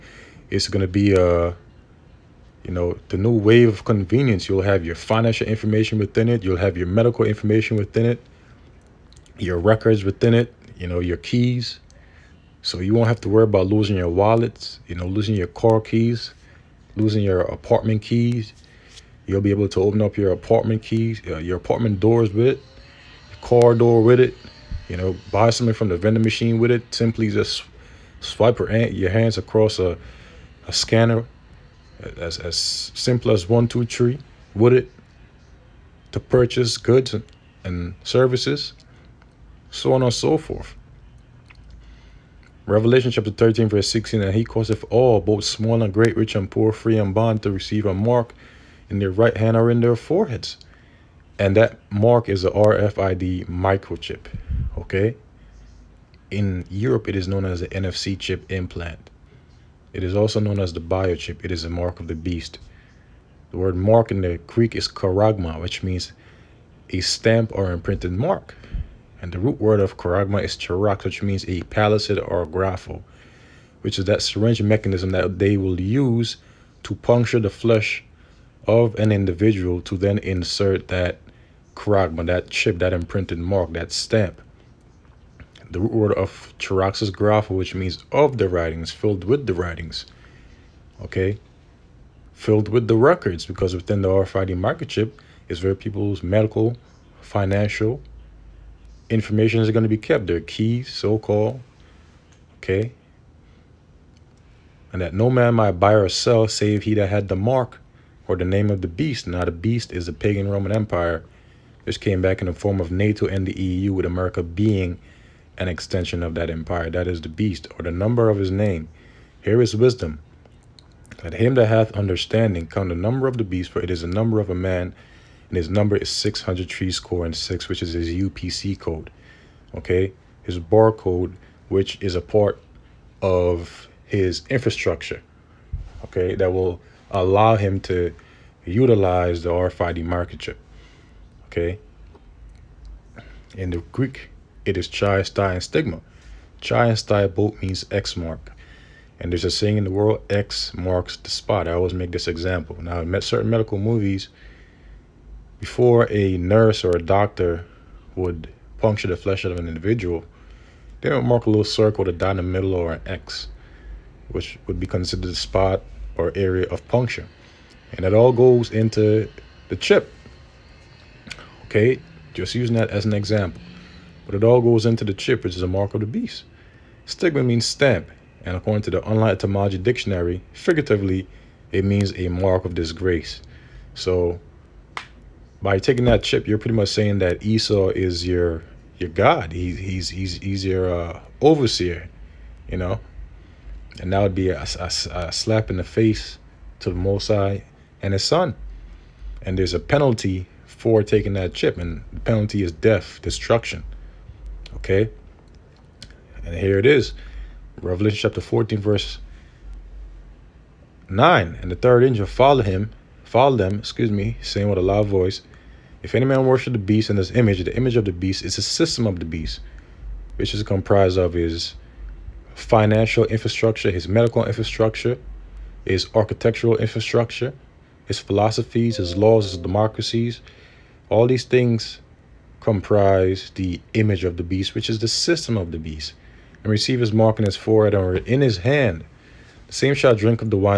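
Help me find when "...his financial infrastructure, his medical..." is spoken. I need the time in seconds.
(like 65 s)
221 s.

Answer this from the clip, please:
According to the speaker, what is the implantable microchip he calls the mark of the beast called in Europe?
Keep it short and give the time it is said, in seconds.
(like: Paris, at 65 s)
NFC chip implant, at 57 s.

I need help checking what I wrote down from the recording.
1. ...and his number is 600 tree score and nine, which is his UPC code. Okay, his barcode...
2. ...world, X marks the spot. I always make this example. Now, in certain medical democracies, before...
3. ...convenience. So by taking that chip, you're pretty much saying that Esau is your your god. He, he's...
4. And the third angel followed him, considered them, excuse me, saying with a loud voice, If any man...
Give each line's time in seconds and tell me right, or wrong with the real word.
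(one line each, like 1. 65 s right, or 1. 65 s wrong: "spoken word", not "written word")
1. 125 s wrong: "six", not "nine"
2. 149 s wrong: "movies", not "democracies"
3. 182 s wrong: "disgrace", not "convenience"
4. 211 s wrong: "followed", not "considered".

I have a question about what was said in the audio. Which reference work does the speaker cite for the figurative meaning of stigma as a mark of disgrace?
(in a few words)
Online Etymology Dictionary.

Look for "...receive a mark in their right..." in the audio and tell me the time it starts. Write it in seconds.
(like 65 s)
47 s.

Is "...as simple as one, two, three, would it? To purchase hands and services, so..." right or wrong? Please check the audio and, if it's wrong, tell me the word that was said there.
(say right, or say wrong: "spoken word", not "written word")
wrong: "goods", not "hands".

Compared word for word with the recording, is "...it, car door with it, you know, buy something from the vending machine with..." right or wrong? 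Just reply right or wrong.
right.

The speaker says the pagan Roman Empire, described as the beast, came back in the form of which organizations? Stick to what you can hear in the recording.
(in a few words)
NATO and the EU.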